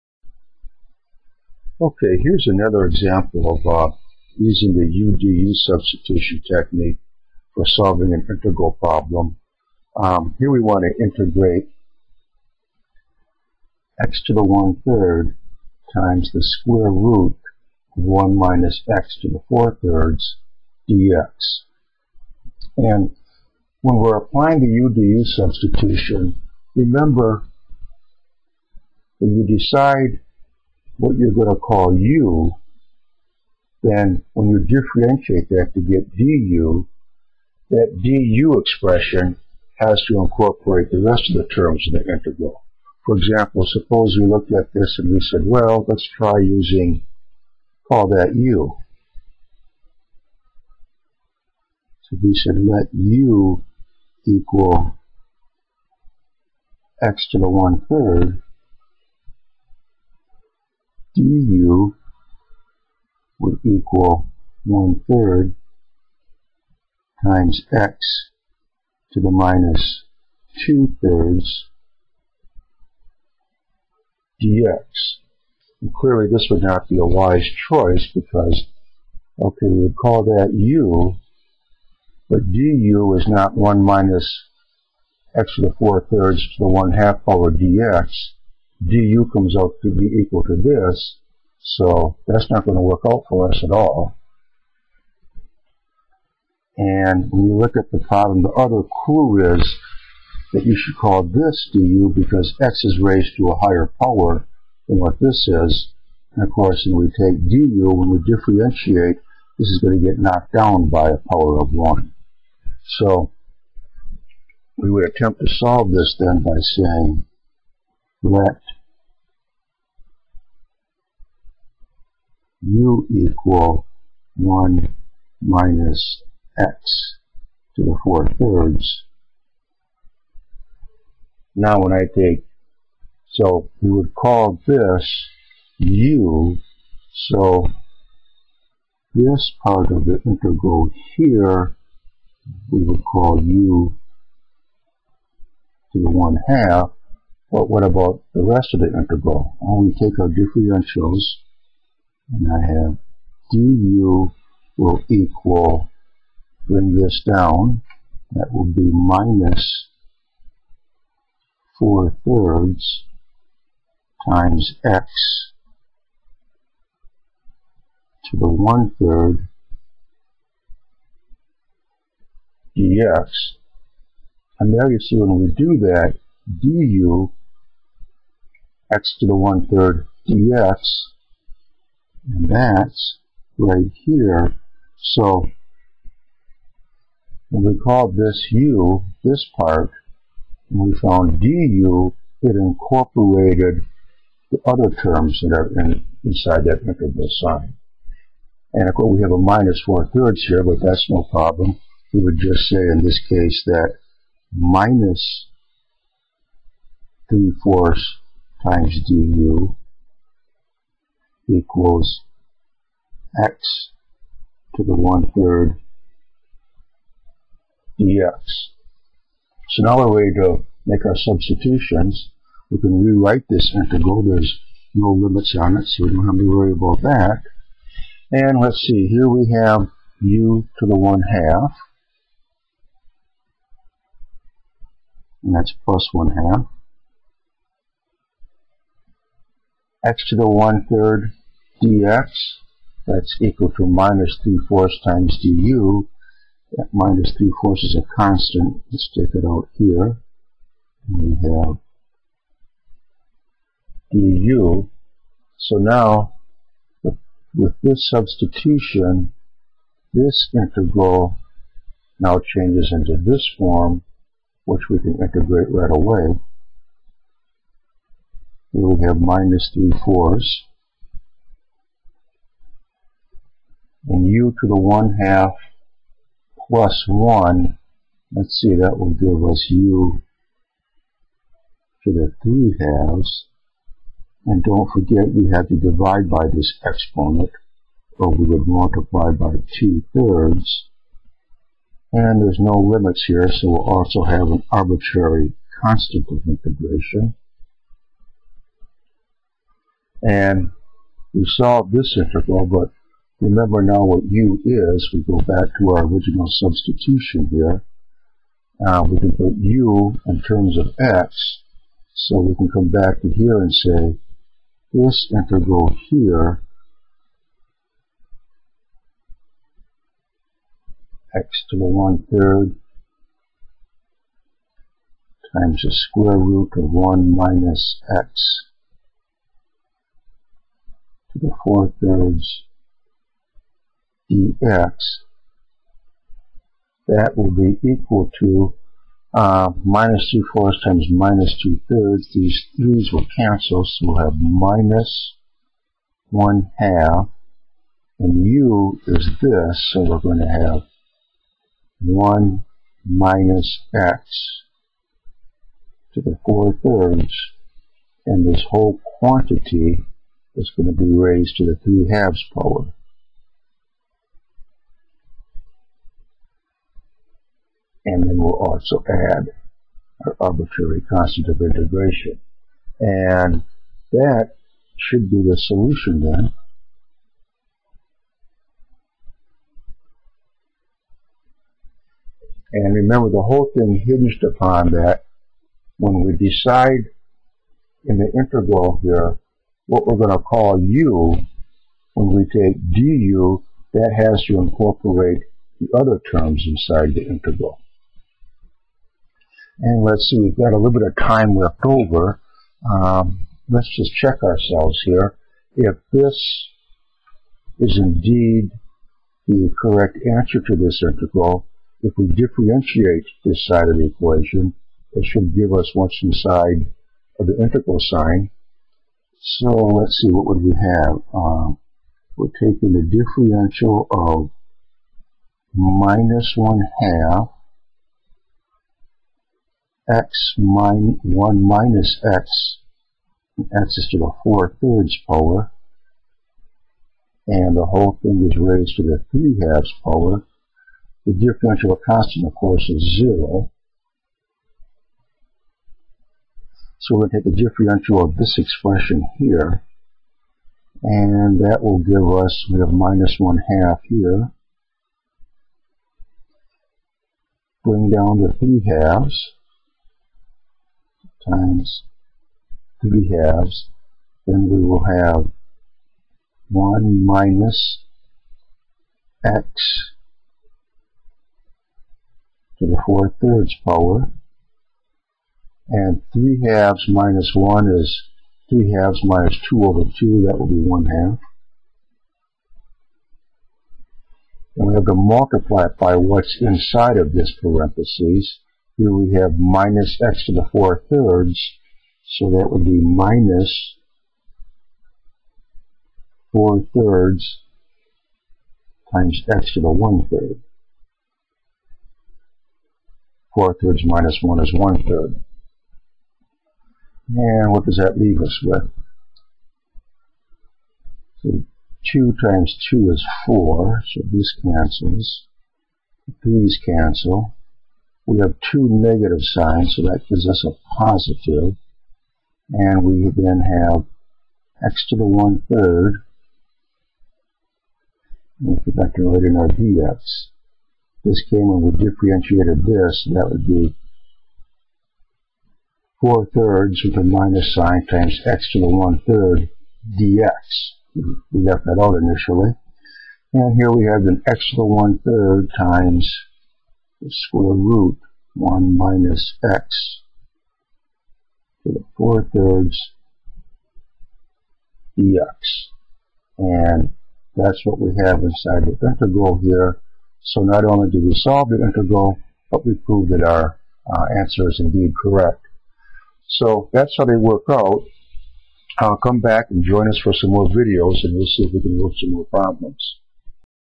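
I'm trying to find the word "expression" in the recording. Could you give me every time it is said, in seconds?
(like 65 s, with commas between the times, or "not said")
38 s, 448 s.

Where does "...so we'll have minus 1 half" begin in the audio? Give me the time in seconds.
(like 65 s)
343 s.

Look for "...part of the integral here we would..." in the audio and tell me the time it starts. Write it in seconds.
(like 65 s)
139 s.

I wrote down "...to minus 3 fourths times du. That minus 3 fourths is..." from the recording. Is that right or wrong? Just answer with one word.
right.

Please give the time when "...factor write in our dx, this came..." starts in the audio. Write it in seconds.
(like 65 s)
528 s.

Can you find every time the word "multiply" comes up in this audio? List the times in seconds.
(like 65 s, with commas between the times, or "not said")
288 s, 485 s.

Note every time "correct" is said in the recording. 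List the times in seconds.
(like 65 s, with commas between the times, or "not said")
409 s, 565 s.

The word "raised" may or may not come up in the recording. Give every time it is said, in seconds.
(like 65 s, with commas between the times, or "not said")
103 s, 361 s, 438 s.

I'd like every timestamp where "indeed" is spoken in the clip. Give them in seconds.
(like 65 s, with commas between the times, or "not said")
408 s, 564 s.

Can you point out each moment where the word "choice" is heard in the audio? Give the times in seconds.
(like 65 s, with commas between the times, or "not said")
77 s.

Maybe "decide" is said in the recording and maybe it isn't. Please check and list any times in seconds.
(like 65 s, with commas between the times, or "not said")
29 s, 386 s.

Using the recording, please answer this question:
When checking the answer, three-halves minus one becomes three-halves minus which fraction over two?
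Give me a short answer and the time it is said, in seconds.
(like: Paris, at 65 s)
2 over 2, at 479 s.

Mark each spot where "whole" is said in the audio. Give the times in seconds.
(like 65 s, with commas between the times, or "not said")
358 s, 383 s, 437 s.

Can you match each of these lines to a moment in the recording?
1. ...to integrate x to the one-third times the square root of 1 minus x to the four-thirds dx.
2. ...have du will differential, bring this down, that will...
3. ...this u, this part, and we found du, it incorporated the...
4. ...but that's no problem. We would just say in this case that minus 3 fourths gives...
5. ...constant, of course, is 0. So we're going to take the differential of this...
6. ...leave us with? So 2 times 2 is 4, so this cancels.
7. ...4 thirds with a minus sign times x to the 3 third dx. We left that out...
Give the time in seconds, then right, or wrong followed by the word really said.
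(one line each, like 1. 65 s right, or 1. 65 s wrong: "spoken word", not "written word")
1. 10 s right
2. 152 s wrong: "equal", not "differential"
3. 188 s right
4. 200 s wrong: "times", not "gives"
5. 442 s right
6. 508 s right
7. 536 s wrong: "1", not "3".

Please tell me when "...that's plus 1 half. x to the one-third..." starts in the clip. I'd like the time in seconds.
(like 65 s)
235 s.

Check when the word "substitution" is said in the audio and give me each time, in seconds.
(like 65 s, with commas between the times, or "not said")
5 s, 25 s, 221 s, 258 s, 306 s.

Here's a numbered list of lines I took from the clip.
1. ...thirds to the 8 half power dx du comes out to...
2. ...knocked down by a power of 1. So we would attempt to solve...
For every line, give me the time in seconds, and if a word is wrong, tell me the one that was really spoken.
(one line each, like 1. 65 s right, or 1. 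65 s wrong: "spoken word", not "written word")
1. 86 s wrong: "1", not "8"
2. 110 s right.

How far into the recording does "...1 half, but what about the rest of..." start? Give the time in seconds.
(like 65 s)
146 s.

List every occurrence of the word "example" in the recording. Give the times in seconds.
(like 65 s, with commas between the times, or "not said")
2 s, 43 s.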